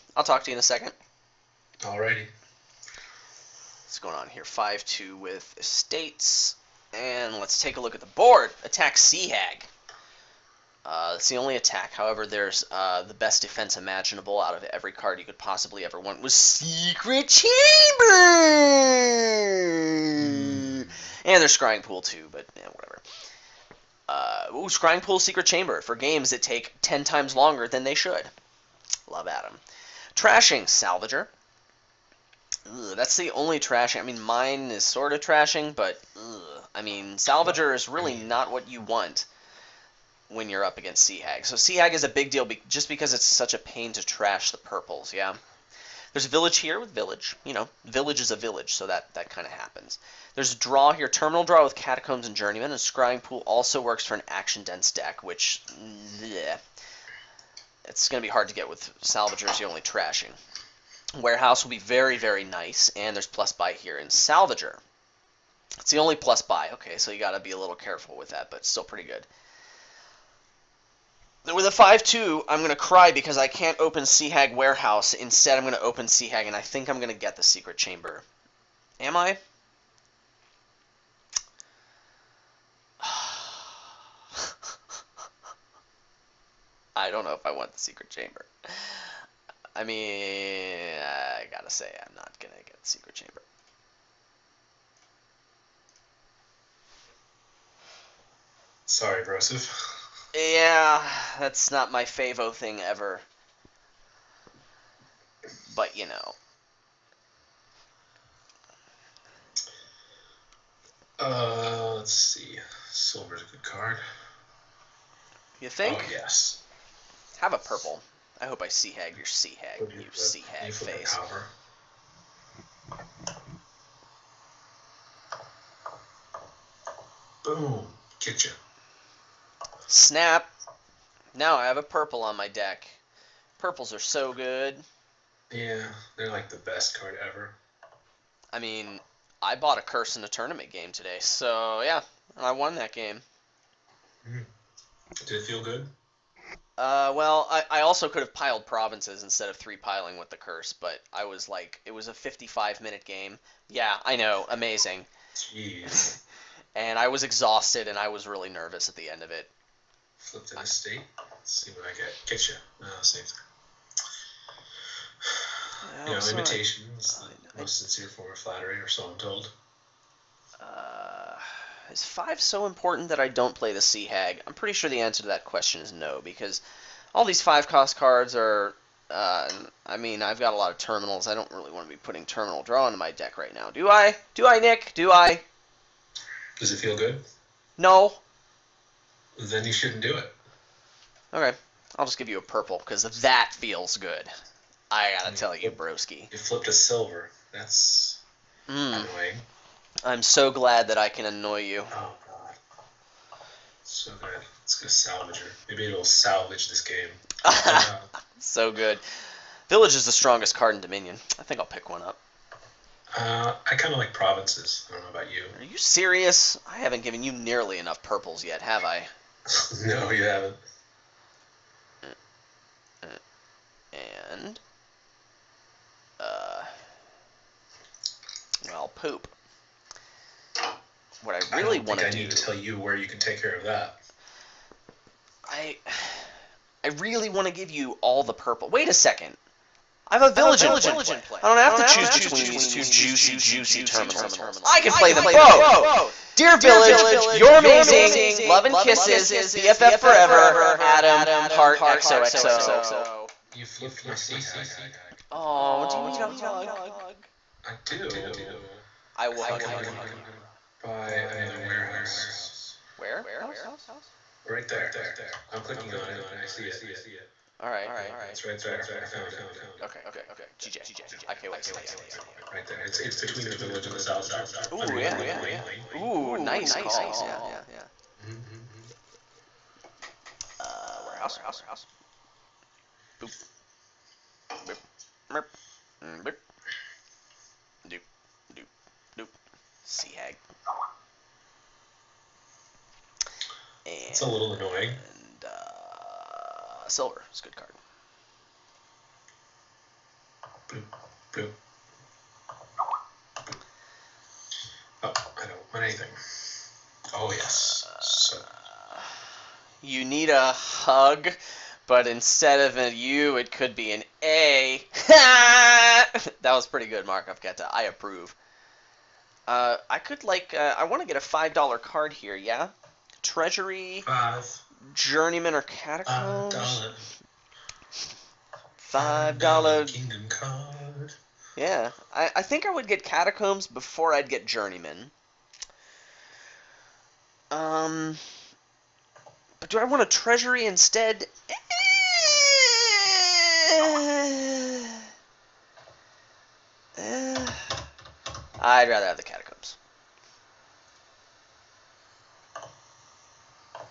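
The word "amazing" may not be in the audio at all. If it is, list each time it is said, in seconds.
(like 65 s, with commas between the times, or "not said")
154 s, 247 s.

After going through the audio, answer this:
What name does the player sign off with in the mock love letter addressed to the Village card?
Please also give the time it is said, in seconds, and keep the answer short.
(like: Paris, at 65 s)
Adam Hart, at 250 s.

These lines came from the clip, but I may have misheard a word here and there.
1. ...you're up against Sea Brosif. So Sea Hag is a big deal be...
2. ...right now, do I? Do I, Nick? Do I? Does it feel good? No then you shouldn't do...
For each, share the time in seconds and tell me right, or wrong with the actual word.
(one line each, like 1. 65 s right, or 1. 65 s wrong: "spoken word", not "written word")
1. 40 s wrong: "Hag", not "Brosif"
2. 183 s right.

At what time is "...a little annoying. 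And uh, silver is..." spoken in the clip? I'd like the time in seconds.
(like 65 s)
294 s.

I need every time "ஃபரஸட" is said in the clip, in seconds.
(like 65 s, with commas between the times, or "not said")
not said.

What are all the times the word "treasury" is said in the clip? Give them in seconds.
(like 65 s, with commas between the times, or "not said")
323 s, 340 s.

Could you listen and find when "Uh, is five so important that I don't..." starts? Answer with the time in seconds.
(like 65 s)
170 s.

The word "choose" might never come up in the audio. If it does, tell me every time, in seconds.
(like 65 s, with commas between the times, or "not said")
241 s.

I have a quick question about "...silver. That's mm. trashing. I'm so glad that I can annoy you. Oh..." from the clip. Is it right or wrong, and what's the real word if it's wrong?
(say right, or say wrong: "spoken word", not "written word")
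wrong: "annoying", not "trashing".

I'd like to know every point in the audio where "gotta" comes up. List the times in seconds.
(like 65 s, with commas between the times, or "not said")
91 s, 195 s.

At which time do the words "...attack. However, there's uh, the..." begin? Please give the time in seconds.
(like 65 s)
11 s.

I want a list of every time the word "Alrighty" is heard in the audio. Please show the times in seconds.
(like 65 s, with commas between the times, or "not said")
1 s.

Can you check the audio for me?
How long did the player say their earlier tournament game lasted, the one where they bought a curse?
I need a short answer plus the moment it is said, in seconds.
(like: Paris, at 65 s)
55 minutes, at 152 s.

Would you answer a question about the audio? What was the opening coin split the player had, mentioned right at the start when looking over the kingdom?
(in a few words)
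5/2.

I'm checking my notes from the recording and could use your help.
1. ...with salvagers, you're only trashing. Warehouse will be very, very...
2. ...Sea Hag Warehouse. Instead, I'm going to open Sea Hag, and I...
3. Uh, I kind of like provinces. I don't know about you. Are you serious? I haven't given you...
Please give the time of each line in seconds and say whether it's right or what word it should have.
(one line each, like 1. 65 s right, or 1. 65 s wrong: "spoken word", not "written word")
1. 58 s right
2. 74 s right
3. 213 s right.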